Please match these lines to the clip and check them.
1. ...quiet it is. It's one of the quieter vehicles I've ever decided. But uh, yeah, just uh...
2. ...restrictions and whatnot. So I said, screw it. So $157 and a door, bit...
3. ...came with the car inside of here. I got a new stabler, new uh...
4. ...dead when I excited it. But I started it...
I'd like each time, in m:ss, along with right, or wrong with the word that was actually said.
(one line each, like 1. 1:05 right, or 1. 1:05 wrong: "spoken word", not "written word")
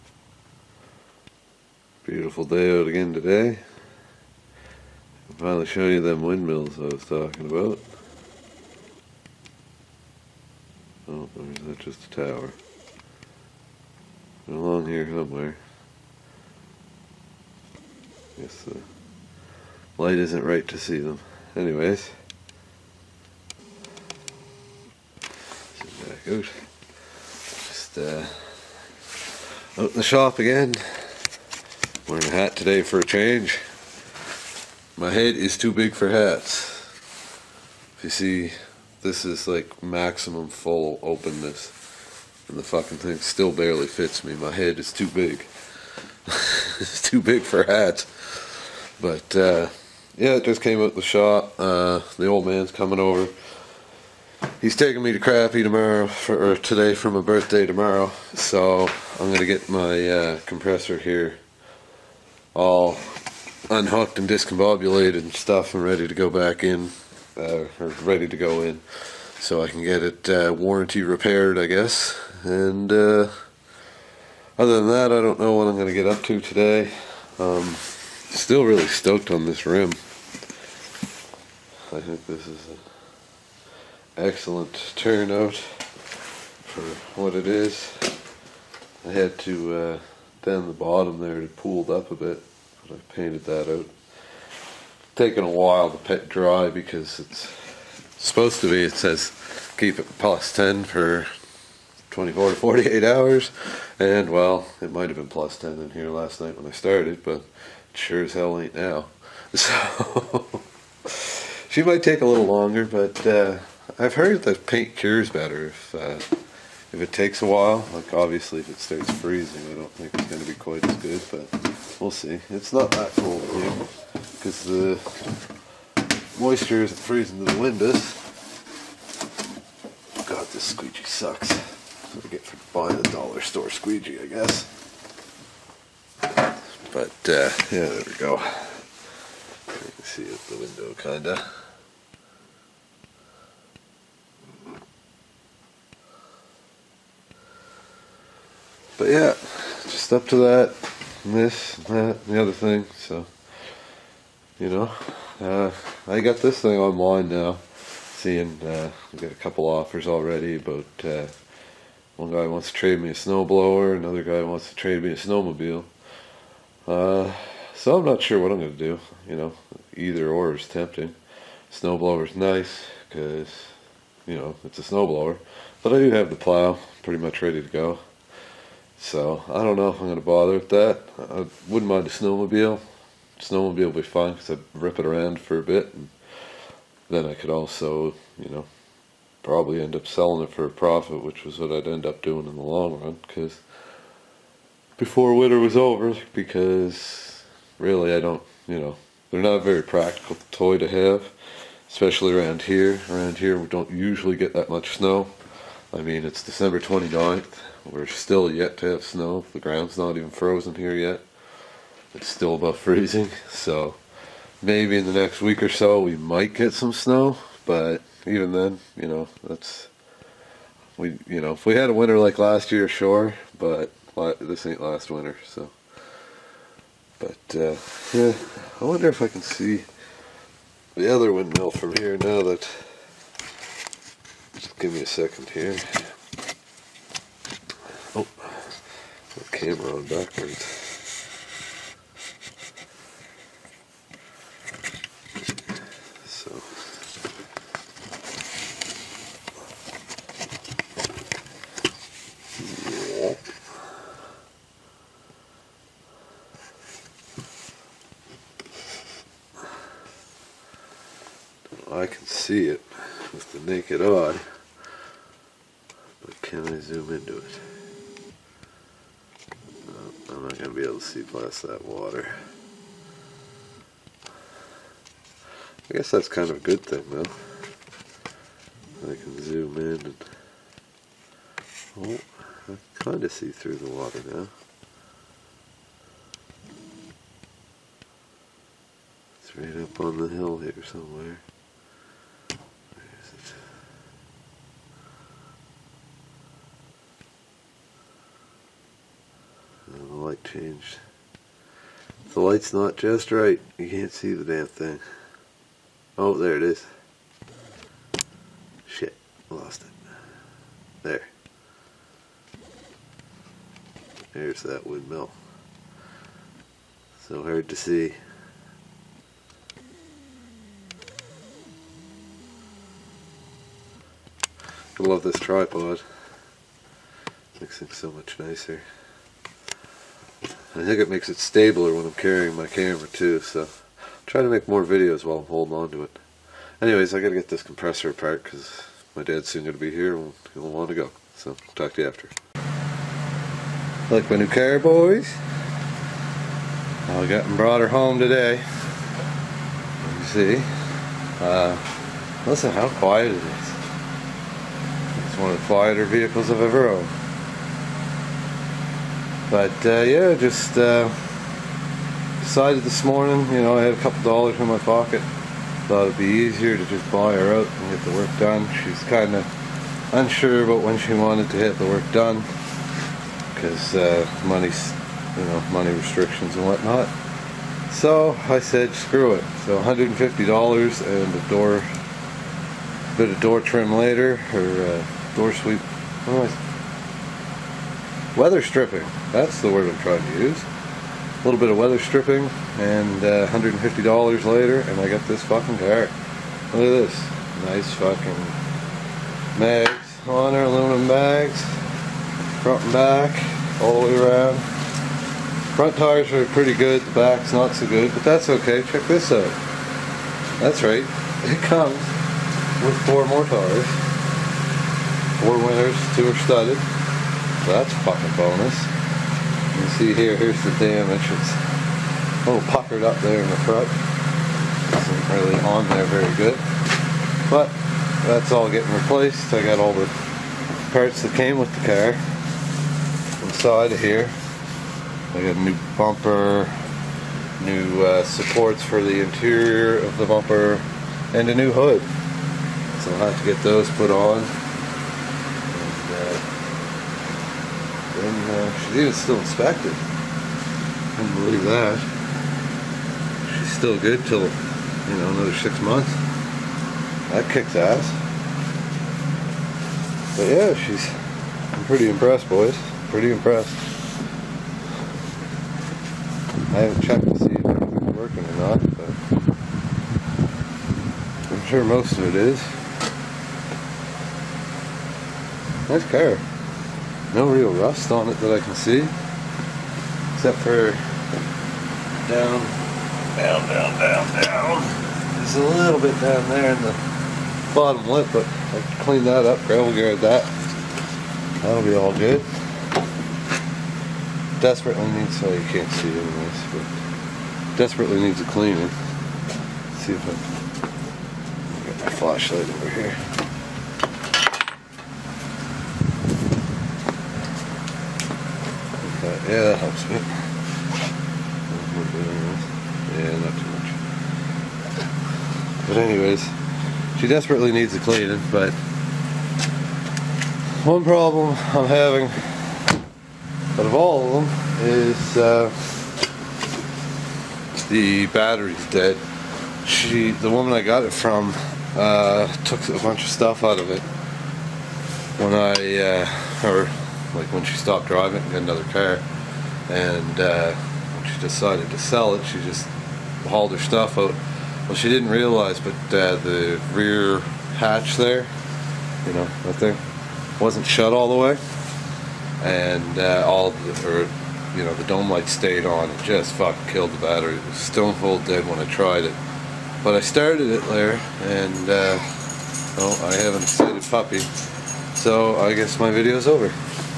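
1. 5:52 wrong: "owned", not "decided"
2. 6:15 wrong: "150", not "157"
3. 7:11 wrong: "bumper", not "stabler"
4. 9:18 wrong: "tried", not "excited".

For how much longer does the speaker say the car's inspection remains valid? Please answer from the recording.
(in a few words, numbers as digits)
six months.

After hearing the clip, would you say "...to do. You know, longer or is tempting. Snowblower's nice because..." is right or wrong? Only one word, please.
wrong.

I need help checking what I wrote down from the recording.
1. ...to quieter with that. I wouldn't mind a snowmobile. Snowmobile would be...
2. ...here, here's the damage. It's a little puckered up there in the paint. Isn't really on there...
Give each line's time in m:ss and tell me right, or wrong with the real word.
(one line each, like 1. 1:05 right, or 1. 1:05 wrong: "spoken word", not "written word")
1. 3:00 wrong: "bother", not "quieter"
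2. 7:00 wrong: "front", not "paint".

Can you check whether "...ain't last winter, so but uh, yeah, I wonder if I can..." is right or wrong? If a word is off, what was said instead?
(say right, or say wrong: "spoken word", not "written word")
right.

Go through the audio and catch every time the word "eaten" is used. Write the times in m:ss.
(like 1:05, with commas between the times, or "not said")
not said.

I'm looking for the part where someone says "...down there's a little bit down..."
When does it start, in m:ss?
8:04.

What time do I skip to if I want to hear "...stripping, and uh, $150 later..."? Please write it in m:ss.
6:31.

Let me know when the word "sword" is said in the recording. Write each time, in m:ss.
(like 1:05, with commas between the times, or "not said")
not said.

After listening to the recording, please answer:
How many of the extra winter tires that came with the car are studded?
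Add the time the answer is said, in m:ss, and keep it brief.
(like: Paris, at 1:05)
2, at 6:56.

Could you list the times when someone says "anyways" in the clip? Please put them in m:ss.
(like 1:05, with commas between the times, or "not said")
0:21, 5:36, 8:16, 8:35.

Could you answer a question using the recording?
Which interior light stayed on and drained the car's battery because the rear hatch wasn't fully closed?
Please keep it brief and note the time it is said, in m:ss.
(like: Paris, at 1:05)
dome light, at 9:15.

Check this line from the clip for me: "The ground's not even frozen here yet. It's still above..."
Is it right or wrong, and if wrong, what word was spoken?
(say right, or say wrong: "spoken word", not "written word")
right.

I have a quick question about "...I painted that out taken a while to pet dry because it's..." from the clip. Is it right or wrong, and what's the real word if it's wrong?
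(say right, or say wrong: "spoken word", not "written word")
right.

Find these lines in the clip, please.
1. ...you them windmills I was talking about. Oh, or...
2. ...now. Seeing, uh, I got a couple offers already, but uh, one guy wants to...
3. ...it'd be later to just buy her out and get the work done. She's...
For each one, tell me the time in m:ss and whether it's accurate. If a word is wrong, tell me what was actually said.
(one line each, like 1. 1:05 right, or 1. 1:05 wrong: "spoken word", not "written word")
1. 0:05 right
2. 2:37 right
3. 6:06 wrong: "easier", not "later".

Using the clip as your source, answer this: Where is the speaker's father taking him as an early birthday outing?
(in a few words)
Crappy.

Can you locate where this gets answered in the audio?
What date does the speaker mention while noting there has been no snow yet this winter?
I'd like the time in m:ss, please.
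3:26.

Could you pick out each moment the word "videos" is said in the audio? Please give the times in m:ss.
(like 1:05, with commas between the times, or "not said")
5:34, 9:26.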